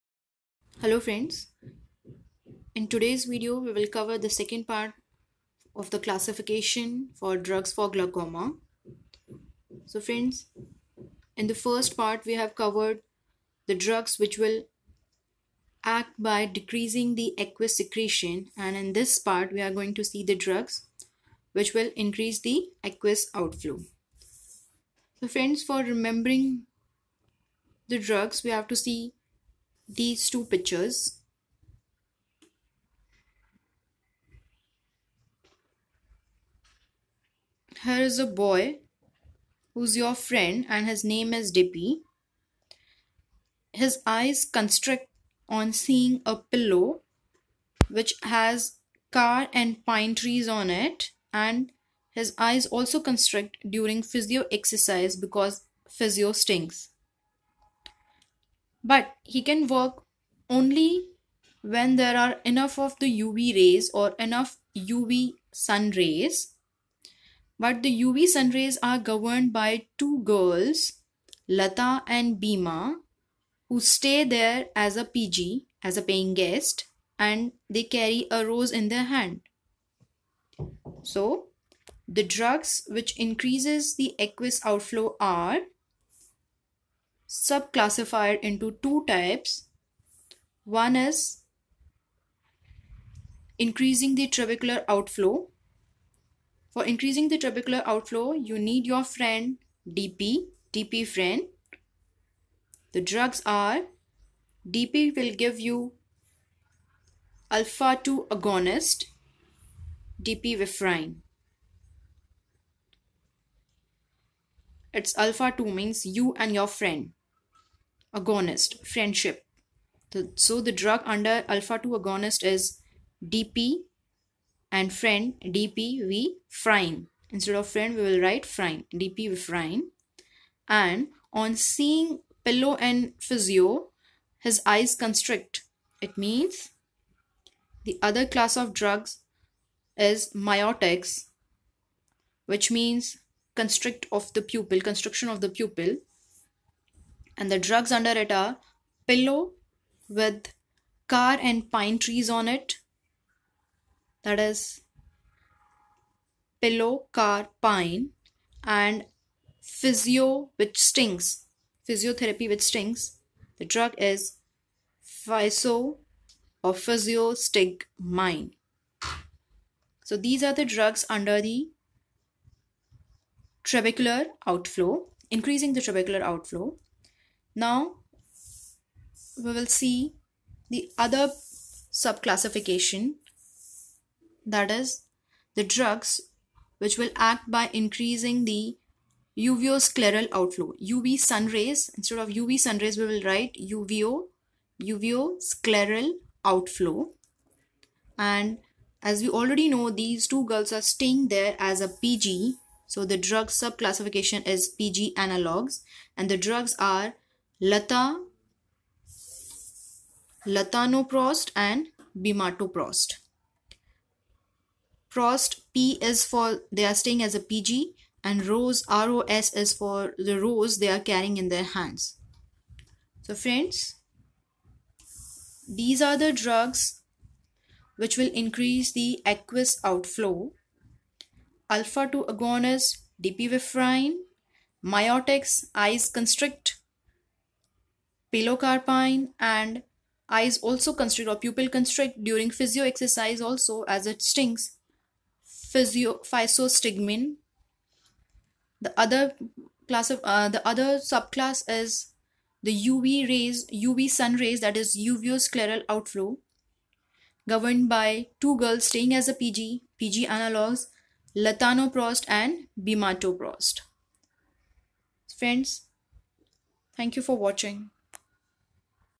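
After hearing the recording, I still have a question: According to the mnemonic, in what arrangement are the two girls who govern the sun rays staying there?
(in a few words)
paying guest.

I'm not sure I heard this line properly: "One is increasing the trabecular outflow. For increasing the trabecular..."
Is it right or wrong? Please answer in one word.
right.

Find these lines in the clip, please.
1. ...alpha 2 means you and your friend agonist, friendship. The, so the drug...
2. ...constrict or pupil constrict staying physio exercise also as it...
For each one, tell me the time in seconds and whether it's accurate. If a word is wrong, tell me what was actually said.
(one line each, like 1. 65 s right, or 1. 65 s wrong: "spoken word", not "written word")
1. 115 s right
2. 240 s wrong: "during", not "staying".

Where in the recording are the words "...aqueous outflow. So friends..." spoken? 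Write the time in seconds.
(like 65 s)
22 s.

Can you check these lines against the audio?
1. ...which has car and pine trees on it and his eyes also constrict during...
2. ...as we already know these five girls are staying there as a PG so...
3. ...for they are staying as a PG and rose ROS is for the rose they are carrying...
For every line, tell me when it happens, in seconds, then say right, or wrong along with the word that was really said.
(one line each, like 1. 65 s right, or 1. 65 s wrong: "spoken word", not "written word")
1. 47 s right
2. 199 s wrong: "two", not "five"
3. 216 s right.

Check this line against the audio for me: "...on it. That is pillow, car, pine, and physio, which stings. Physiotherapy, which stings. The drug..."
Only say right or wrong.
right.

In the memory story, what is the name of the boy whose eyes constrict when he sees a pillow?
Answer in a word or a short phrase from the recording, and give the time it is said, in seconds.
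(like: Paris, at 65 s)
Dippy, at 41 s.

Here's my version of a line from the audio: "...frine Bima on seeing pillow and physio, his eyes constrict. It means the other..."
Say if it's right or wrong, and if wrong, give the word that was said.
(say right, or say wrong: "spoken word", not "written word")
wrong: "And", not "Bima".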